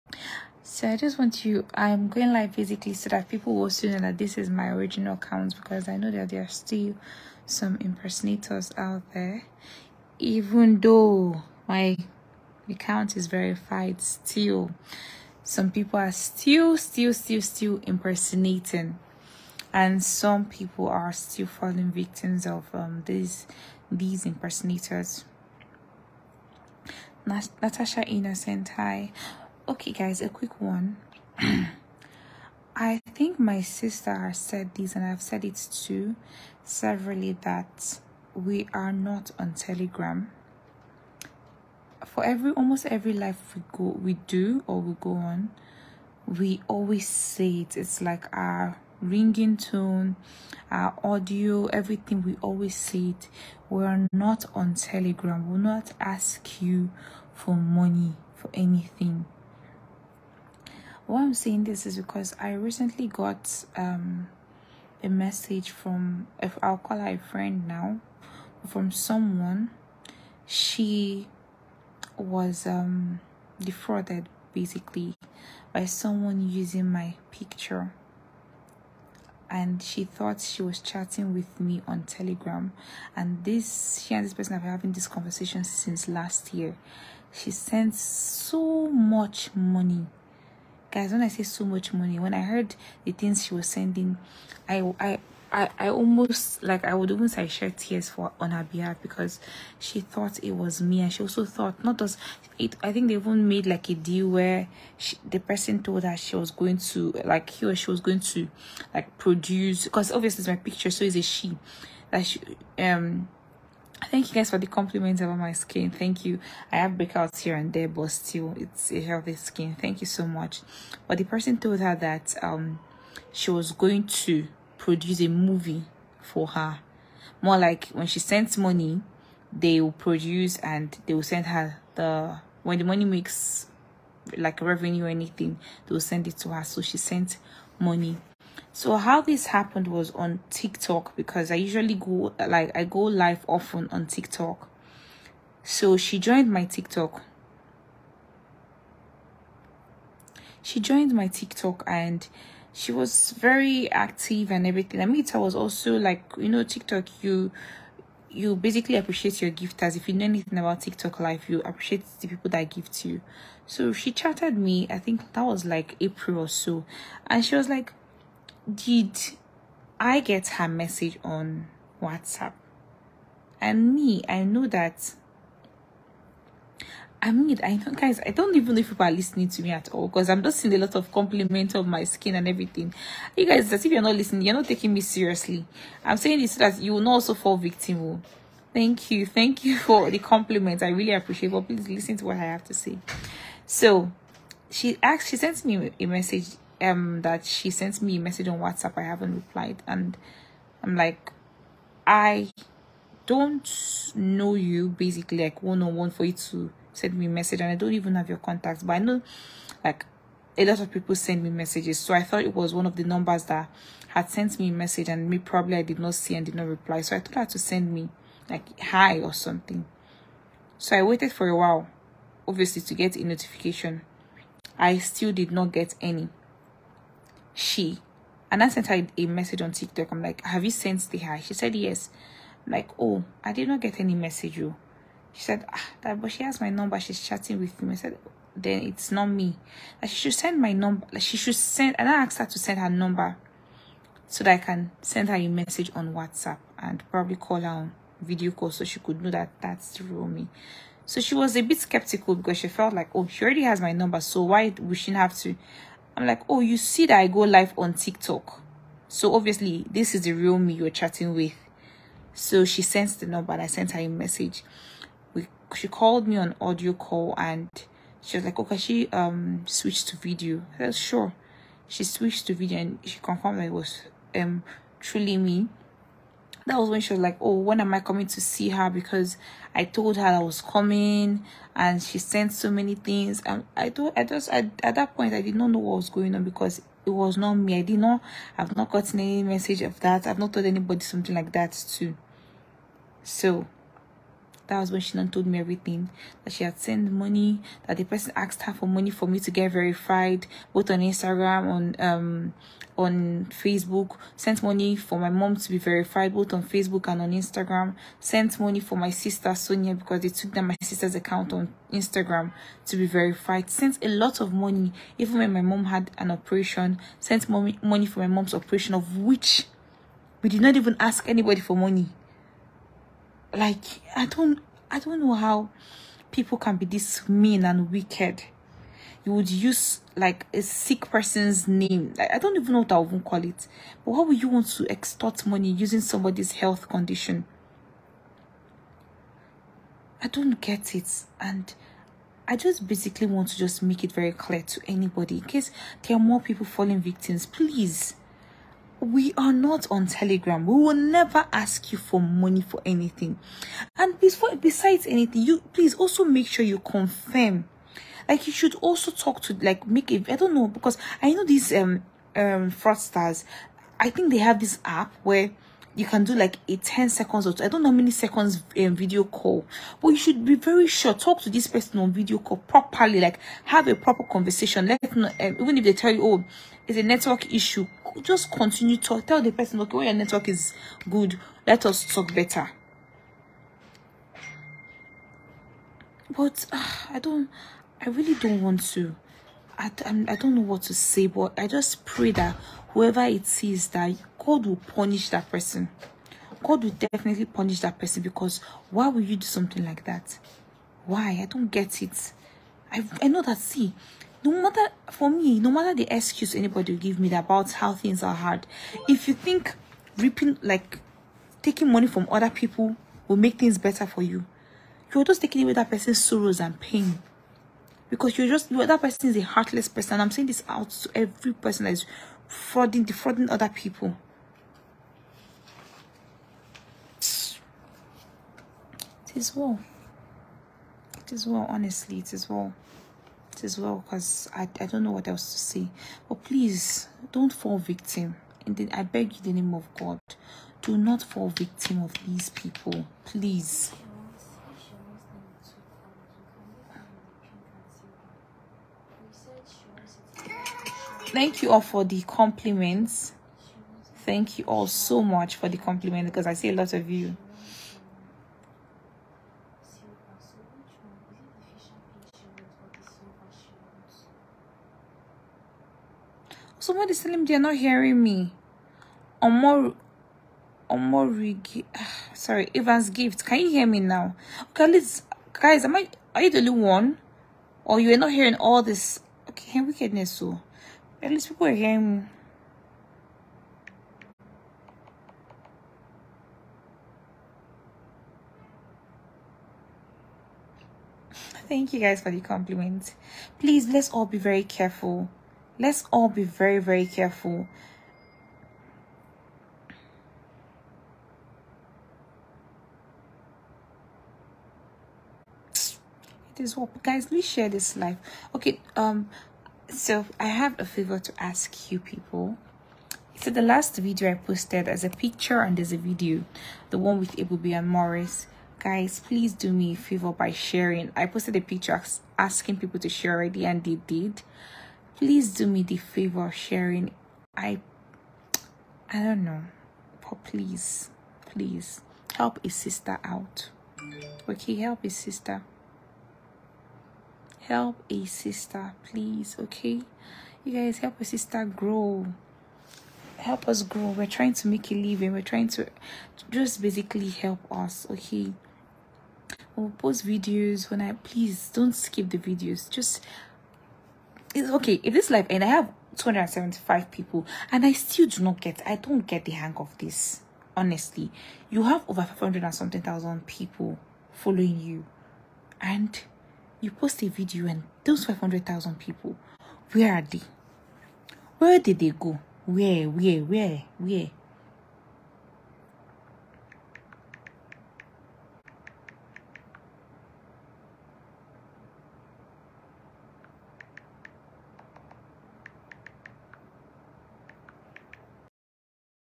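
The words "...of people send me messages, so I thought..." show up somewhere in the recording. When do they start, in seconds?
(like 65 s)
210 s.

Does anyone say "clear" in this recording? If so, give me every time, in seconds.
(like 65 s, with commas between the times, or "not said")
344 s.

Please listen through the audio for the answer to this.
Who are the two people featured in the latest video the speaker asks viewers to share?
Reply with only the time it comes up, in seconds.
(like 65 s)
517 s.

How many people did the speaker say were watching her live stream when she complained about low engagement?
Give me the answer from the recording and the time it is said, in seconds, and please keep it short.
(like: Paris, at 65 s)
275, at 556 s.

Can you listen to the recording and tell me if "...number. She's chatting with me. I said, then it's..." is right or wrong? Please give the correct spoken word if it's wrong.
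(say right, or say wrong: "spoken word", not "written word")
right.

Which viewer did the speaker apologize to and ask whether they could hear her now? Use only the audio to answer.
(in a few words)
Evans Gift.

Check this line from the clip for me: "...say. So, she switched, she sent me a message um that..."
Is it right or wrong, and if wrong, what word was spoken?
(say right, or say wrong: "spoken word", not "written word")
wrong: "asked", not "switched".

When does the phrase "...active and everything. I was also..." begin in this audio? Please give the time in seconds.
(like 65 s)
153 s.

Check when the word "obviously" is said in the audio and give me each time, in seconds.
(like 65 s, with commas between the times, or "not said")
110 s, 222 s, 259 s.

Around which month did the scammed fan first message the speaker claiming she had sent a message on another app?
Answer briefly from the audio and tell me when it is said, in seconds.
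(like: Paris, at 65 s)
April, at 165 s.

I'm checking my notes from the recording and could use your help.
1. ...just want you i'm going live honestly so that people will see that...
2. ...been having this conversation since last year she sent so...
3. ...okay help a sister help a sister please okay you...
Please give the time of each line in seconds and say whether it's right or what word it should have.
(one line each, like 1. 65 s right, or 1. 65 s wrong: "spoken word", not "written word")
1. 0 s wrong: "basically", not "honestly"
2. 84 s right
3. 534 s right.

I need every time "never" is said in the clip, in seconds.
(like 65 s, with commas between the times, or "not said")
350 s.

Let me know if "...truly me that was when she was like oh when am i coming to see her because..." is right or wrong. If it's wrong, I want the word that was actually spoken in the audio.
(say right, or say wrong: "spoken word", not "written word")
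right.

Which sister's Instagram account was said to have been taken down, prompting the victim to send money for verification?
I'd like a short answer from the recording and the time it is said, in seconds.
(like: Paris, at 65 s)
Sonia, at 309 s.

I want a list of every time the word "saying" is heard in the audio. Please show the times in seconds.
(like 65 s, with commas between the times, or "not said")
61 s, 186 s, 420 s.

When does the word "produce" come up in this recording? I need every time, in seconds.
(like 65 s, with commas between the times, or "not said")
109 s, 124 s, 129 s.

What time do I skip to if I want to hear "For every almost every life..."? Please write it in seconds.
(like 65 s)
42 s.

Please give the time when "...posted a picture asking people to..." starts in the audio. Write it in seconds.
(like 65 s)
521 s.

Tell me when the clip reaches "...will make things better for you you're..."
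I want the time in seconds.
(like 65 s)
413 s.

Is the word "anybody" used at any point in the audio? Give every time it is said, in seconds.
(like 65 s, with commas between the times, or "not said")
290 s, 321 s, 344 s, 406 s.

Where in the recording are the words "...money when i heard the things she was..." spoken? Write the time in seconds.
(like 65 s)
91 s.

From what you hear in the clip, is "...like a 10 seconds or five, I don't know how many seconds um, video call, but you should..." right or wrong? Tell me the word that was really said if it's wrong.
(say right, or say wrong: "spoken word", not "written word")
wrong: "two", not "five".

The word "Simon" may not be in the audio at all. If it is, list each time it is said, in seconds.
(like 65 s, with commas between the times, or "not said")
not said.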